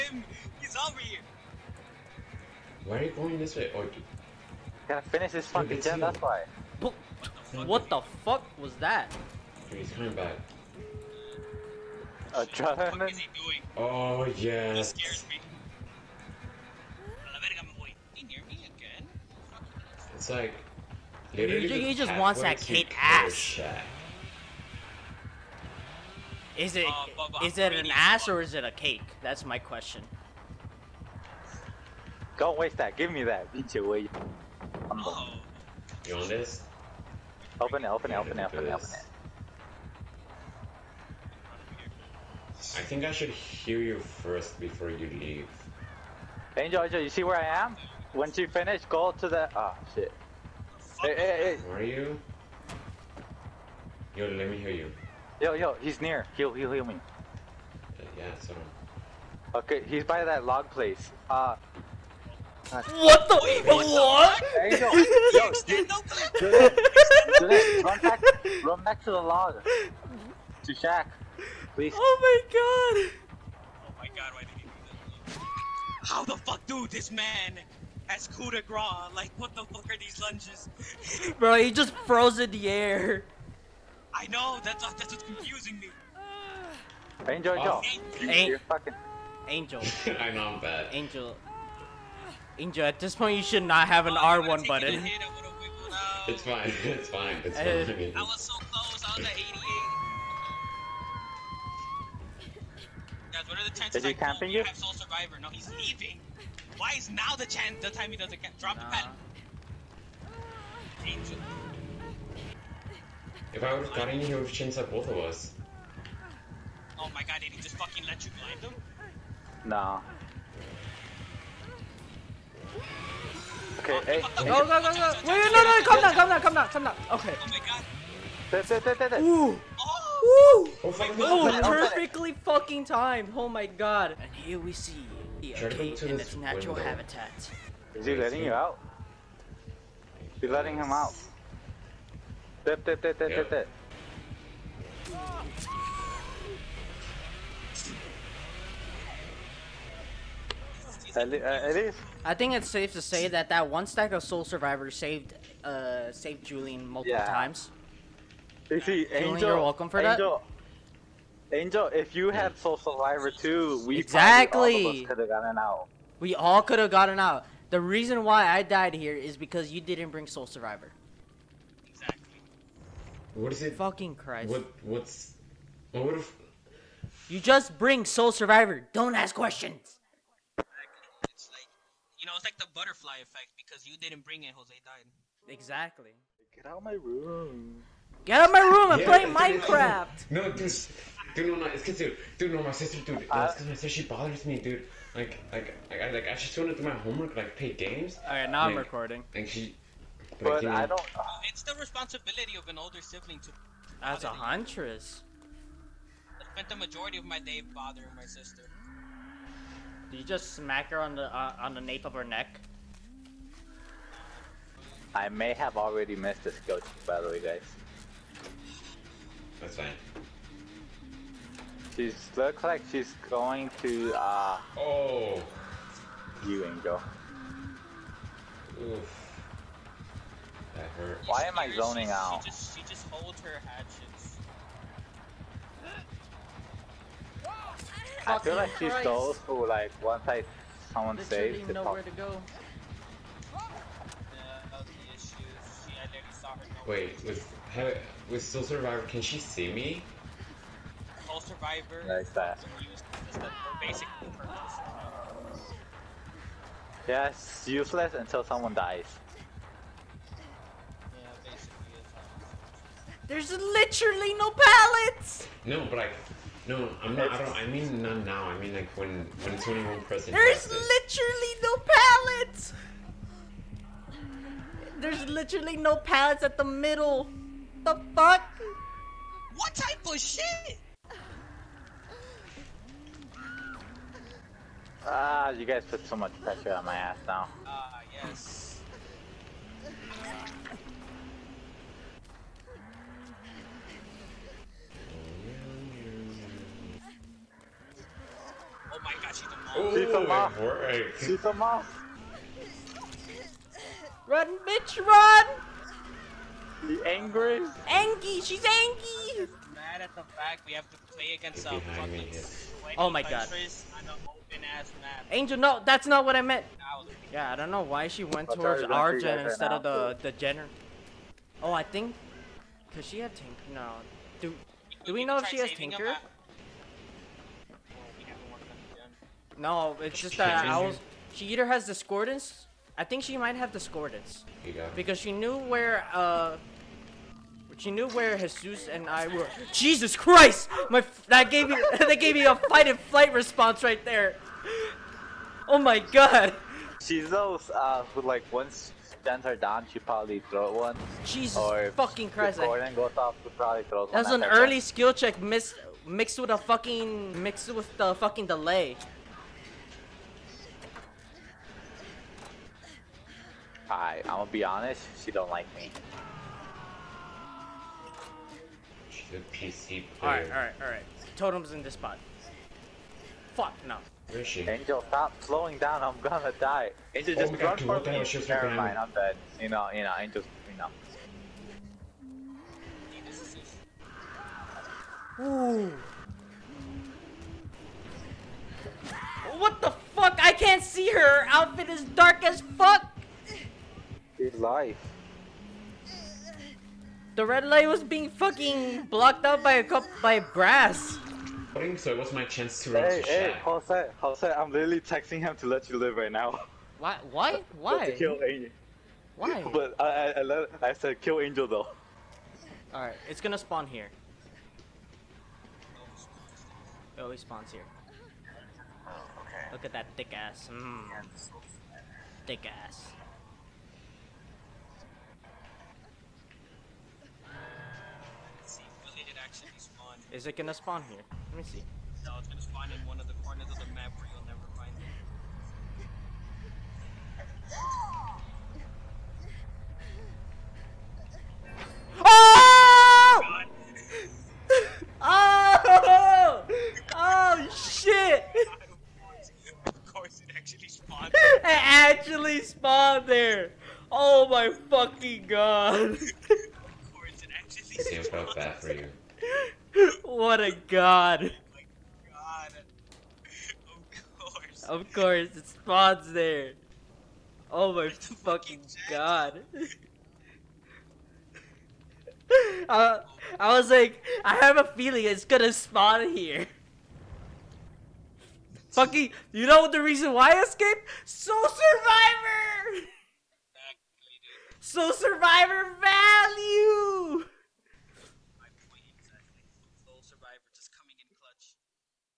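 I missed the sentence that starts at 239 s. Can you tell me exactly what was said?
those who like once I someone Literally saves, nowhere to go.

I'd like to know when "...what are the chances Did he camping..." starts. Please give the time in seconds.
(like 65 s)
103 s.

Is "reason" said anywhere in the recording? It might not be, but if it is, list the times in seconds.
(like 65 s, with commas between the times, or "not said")
167 s, 480 s.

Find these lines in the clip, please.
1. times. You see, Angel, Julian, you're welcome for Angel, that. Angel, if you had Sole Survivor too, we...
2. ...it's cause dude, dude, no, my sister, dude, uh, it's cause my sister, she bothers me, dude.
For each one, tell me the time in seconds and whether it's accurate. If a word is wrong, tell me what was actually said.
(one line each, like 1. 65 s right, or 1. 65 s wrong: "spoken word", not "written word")
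1. 157 s right
2. 191 s right.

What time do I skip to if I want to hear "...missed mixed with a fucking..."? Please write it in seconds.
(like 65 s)
355 s.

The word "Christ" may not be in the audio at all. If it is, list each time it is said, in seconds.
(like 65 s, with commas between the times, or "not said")
174 s, 238 s, 340 s, 352 s.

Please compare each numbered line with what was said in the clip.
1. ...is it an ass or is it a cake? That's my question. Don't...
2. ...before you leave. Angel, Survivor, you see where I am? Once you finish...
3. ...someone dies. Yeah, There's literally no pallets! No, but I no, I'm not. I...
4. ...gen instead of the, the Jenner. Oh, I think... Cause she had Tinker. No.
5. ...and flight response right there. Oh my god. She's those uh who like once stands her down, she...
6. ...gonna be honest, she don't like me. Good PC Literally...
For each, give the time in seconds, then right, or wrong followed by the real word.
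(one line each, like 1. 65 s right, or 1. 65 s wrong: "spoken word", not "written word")
1. 27 s right
2. 44 s wrong: "Angel", not "Survivor"
3. 258 s right
4. 319 s right
5. 342 s right
6. 364 s wrong: "Alright", not "Literally".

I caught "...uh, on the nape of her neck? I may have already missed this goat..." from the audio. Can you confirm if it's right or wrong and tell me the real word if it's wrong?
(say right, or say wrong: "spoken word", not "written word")
right.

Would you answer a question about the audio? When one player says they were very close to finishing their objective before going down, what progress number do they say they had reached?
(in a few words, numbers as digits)
88.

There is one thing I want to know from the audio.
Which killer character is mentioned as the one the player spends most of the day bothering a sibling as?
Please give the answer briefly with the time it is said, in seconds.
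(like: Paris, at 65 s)
Huntress, at 204 s.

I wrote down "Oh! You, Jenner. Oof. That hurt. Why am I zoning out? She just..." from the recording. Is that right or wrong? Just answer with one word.
wrong.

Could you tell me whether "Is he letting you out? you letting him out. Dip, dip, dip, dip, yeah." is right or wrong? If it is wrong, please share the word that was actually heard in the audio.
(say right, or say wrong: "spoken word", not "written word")
right.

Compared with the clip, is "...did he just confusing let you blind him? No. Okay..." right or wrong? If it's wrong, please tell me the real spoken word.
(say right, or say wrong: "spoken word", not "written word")
wrong: "fucking", not "confusing".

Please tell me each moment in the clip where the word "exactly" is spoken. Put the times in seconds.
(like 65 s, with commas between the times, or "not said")
163 s, 171 s, 185 s.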